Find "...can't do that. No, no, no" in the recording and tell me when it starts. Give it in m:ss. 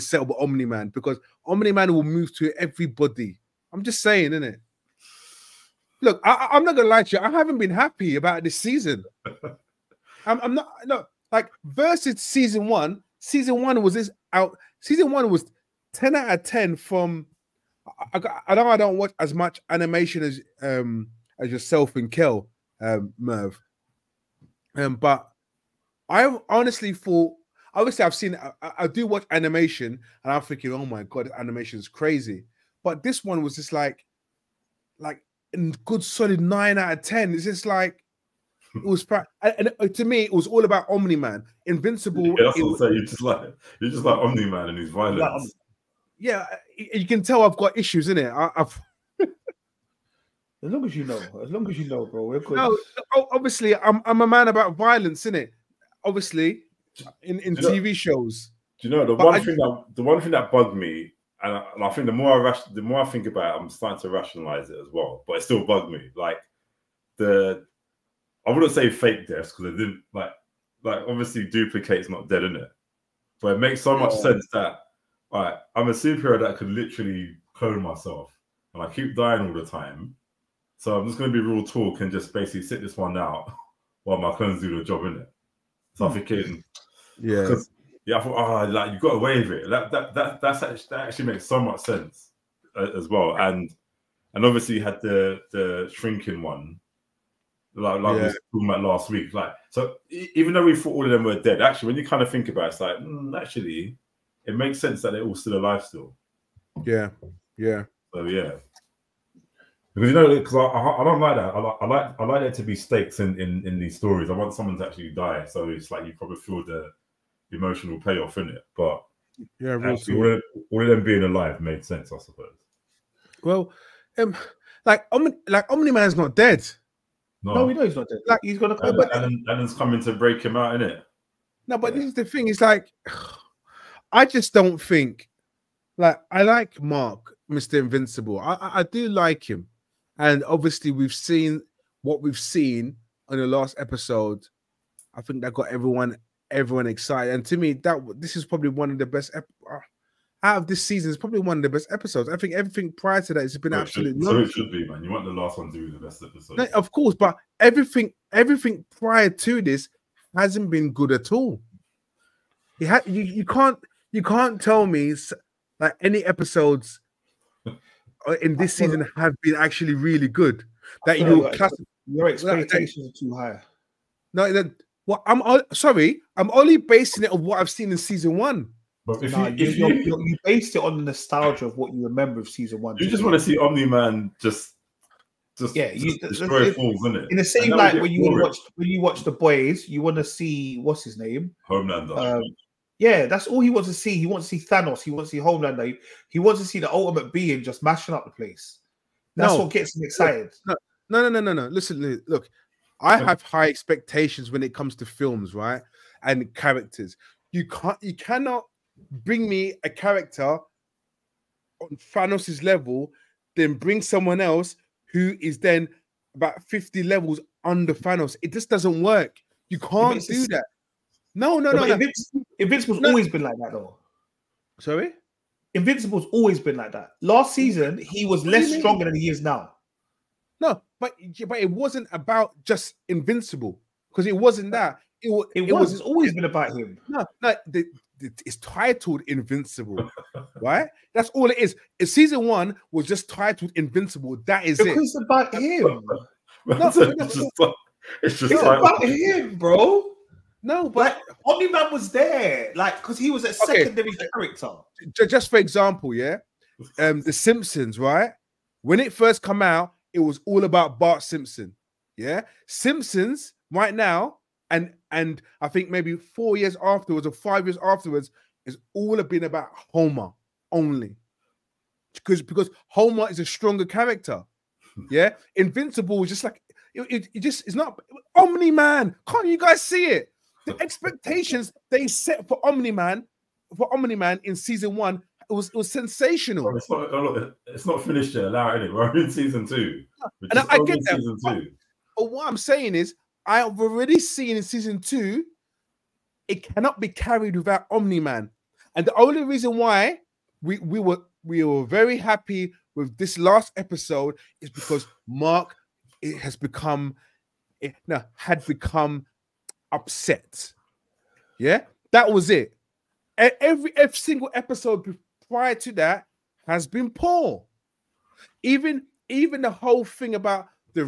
3:39.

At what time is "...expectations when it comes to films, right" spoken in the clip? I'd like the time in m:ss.
3:23.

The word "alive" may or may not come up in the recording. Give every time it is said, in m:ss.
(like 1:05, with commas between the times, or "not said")
1:45, 2:01.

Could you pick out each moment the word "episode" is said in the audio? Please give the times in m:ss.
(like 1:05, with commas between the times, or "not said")
2:23, 2:31, 2:36, 2:46, 5:03, 5:14.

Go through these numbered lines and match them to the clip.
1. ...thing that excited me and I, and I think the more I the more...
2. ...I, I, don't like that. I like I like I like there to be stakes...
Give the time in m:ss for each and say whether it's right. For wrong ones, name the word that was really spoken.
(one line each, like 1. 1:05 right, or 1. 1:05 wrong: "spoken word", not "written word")
1. 1:00 wrong: "bugged", not "excited"
2. 1:50 right.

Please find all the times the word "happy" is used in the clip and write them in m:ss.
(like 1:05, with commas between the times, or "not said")
0:07, 5:02.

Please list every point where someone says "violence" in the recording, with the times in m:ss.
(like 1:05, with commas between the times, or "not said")
0:44, 0:54.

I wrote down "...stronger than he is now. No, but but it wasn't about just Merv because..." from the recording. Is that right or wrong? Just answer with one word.
wrong.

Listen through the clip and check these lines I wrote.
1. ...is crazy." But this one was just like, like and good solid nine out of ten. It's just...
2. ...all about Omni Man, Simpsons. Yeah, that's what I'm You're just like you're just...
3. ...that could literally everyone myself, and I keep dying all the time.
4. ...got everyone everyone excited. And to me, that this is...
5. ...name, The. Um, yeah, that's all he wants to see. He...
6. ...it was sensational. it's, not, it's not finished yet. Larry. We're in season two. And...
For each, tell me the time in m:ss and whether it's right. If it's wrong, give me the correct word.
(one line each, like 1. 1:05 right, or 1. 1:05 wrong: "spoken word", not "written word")
1. 0:31 right
2. 0:40 wrong: "Invincible", not "Simpsons"
3. 1:16 wrong: "clone", not "everyone"
4. 2:25 right
5. 3:11 wrong: "Homelander", not "The"
6. 4:45 right.